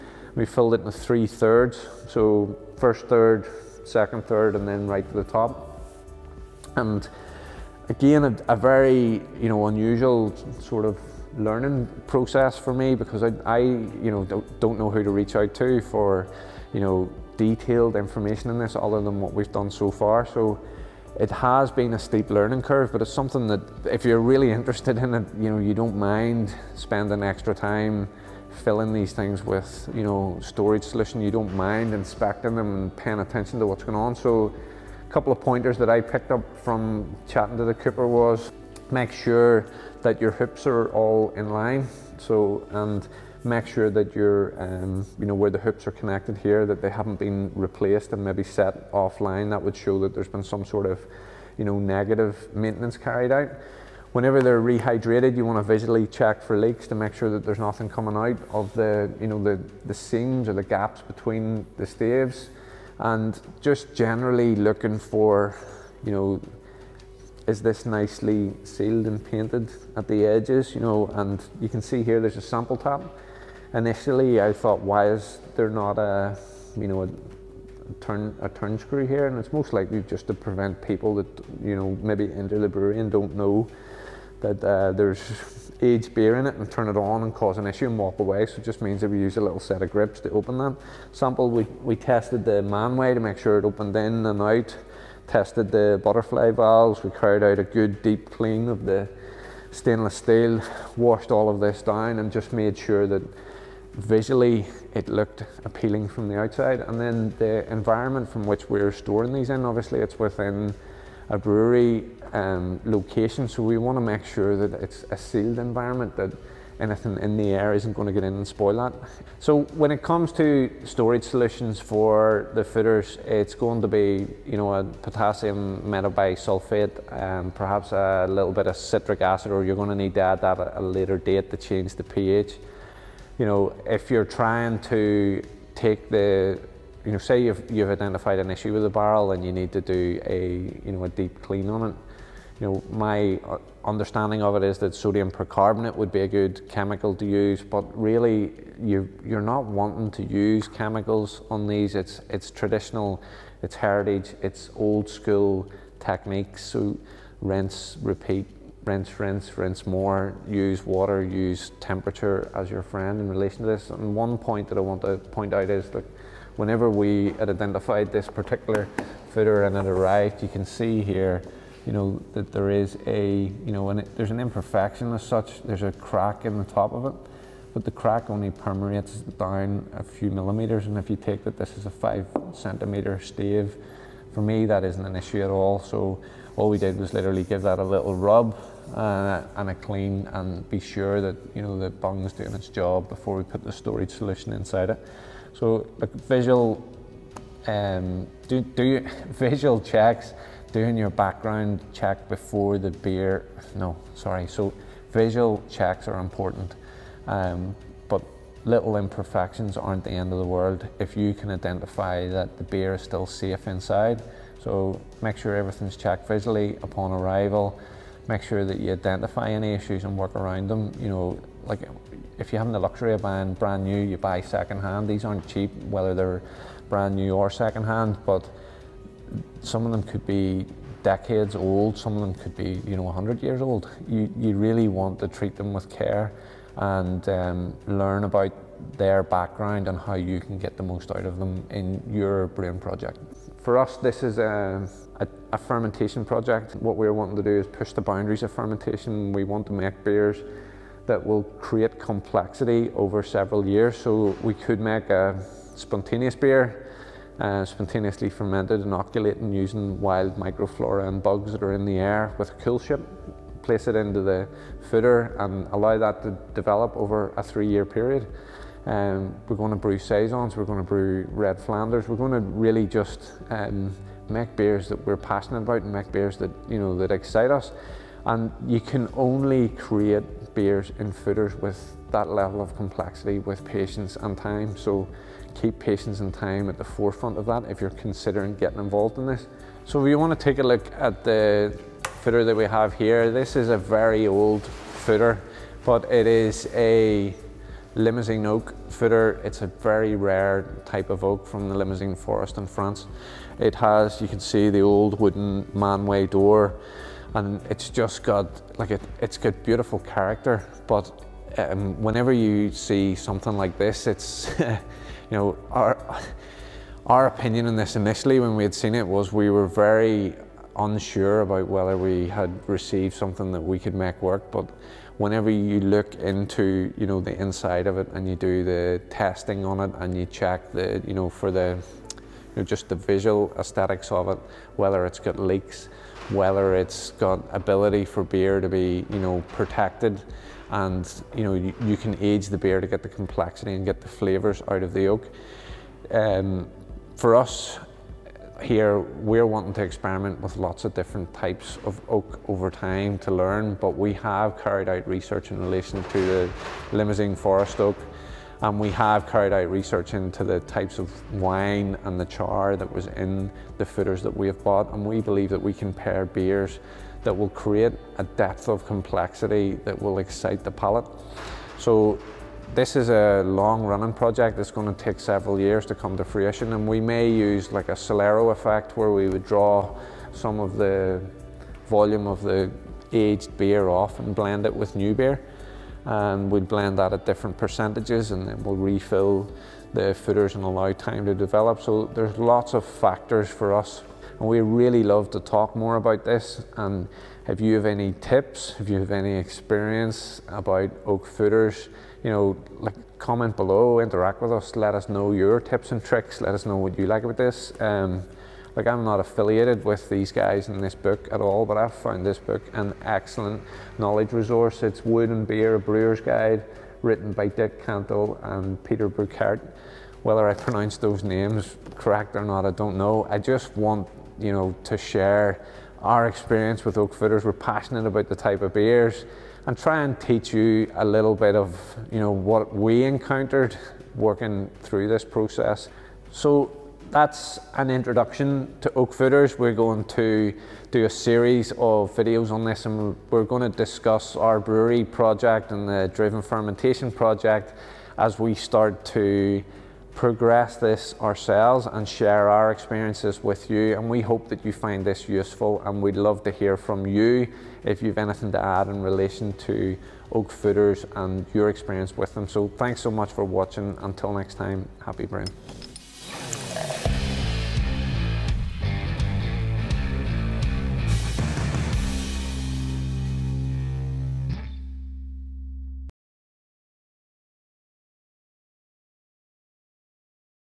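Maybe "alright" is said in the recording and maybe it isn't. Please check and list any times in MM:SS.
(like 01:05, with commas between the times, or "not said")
not said.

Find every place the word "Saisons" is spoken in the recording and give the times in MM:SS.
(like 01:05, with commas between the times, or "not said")
04:29.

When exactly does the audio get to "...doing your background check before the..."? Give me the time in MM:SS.
03:20.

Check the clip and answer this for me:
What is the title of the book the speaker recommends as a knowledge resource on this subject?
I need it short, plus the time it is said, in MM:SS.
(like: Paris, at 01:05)
Wood and Beer, at 06:55.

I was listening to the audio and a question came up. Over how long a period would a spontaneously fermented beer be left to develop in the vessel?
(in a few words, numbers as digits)
3 years.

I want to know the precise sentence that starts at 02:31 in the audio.
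It's, it's traditional, it's heritage, it's old school techniques.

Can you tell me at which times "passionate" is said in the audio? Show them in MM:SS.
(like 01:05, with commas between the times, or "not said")
04:35, 07:07.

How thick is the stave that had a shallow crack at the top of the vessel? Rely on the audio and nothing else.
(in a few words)
5 centimeters.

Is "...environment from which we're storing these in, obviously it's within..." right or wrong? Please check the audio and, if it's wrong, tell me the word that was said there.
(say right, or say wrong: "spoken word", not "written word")
right.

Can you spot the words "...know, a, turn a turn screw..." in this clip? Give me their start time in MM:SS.
01:16.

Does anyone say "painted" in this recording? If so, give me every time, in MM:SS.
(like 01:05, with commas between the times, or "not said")
01:09.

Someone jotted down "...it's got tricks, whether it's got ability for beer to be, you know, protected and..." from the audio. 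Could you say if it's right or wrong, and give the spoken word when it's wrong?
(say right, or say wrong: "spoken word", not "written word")
wrong: "leaks", not "tricks".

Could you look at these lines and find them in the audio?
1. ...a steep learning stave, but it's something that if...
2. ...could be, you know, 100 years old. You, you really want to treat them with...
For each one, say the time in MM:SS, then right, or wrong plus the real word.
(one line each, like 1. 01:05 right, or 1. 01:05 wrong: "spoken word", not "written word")
1. 00:21 wrong: "curve", not "stave"
2. 03:52 right.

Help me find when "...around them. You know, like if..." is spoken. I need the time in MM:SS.
03:40.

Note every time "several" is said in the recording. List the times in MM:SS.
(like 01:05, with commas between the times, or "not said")
04:13, 06:15.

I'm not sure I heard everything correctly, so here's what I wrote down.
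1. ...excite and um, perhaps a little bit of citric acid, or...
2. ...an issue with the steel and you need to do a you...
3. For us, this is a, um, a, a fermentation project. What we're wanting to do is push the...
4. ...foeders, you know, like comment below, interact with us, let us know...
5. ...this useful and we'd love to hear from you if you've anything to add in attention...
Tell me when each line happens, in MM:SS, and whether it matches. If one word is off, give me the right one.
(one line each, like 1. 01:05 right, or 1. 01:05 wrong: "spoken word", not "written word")
1. 02:05 wrong: "metabisulfate", not "excite"
2. 02:18 wrong: "barrel", not "steel"
3. 04:03 right
4. 06:41 right
5. 07:35 wrong: "relation", not "attention".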